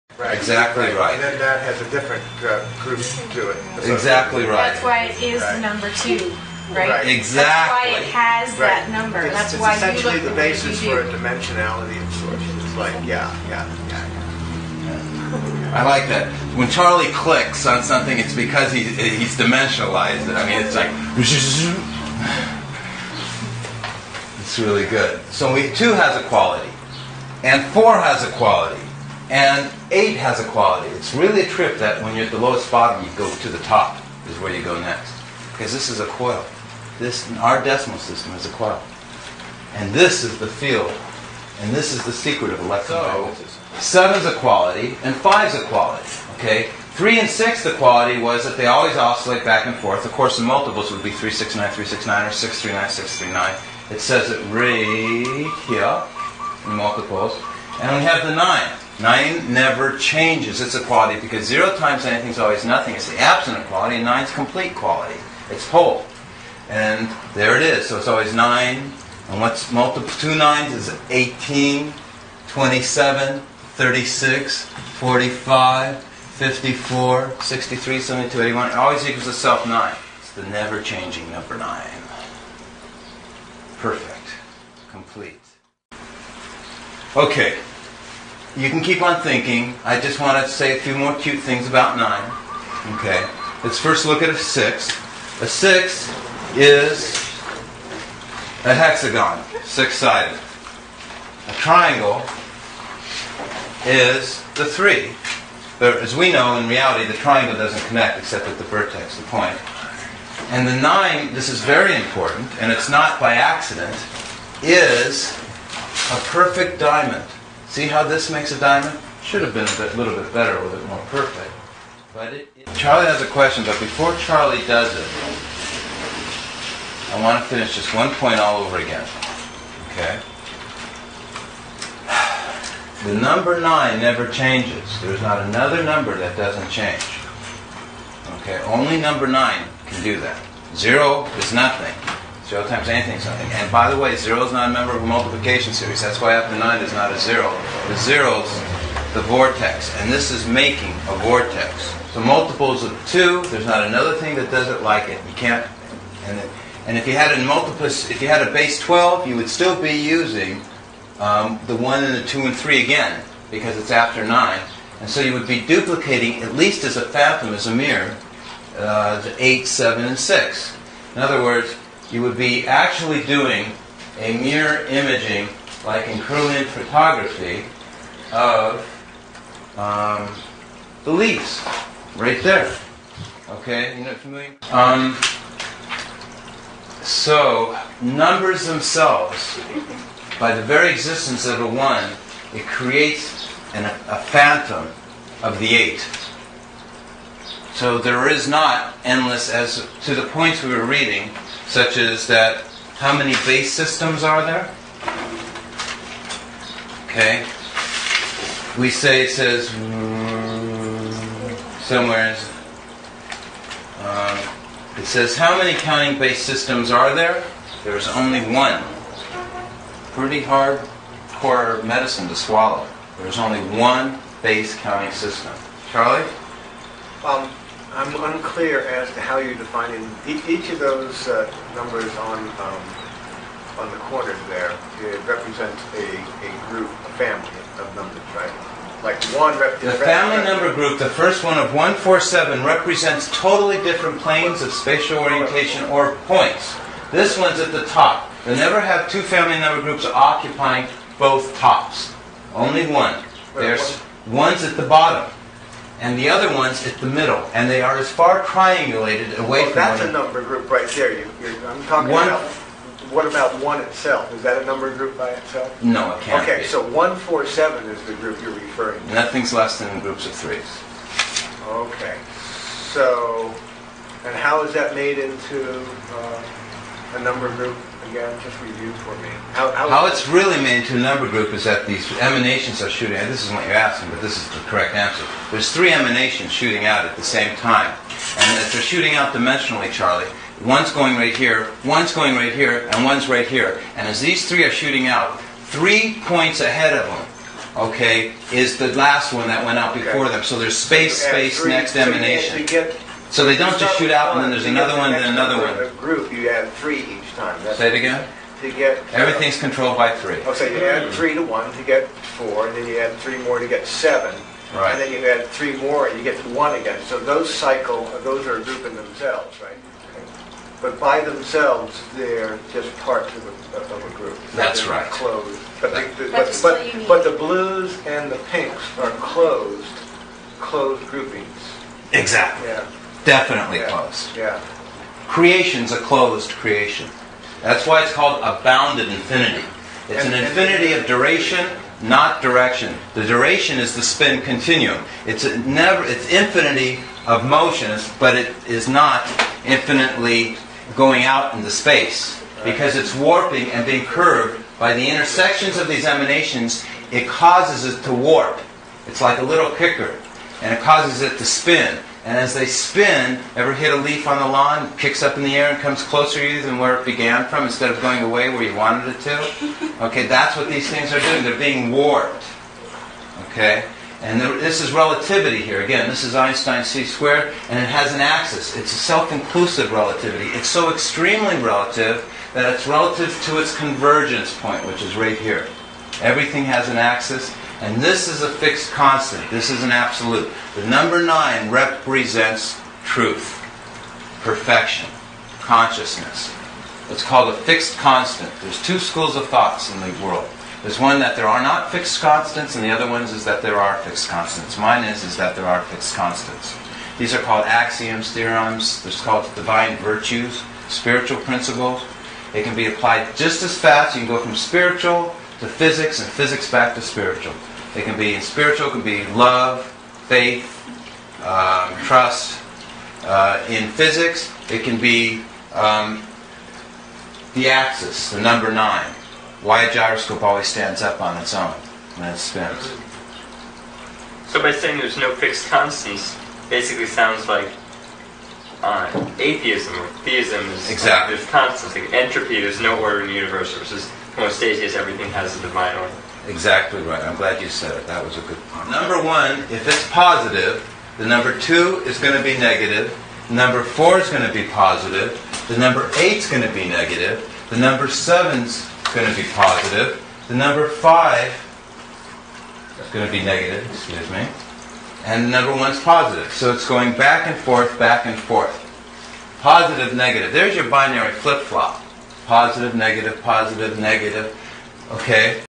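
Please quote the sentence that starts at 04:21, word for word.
You, I'm talking one, about what about one itself?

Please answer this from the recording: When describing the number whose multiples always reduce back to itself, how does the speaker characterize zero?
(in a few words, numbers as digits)
absent of quality.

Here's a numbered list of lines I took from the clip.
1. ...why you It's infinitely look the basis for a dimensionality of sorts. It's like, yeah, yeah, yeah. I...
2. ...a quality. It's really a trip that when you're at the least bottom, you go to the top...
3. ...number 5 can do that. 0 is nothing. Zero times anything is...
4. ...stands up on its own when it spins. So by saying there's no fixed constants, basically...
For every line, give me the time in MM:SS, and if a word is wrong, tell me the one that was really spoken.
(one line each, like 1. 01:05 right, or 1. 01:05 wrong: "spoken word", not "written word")
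1. 00:09 wrong: "essentially", not "infinitely"
2. 00:30 wrong: "lowest", not "least"
3. 02:18 wrong: "9", not "5"
4. 07:10 right.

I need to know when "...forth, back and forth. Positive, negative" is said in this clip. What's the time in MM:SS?
07:47.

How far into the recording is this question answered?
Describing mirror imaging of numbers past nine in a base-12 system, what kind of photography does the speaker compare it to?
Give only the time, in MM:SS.
02:56.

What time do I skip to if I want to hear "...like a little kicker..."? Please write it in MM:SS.
05:59.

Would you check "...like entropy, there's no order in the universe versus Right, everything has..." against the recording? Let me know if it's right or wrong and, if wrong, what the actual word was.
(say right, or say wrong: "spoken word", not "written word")
wrong: "Homeostasis", not "Right".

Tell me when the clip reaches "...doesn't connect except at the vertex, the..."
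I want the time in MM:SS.
01:47.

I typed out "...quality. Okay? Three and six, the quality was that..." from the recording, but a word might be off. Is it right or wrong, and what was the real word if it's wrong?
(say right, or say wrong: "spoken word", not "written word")
right.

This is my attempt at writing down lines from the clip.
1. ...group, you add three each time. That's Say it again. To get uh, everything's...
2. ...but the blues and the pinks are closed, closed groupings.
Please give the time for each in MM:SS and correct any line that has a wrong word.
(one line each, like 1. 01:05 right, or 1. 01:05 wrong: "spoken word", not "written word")
1. 05:05 right
2. 05:27 right.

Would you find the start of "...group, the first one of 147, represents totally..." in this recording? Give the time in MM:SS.
04:00.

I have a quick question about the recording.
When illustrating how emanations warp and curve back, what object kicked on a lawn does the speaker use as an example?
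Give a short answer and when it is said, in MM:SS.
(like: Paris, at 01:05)
a leaf, at 06:03.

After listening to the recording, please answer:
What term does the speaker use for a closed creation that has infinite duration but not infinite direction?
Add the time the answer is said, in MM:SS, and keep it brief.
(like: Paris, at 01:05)
bounded infinity, at 05:38.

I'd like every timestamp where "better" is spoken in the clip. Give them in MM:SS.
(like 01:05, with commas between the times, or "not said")
02:00.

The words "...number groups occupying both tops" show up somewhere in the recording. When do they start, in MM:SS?
04:09.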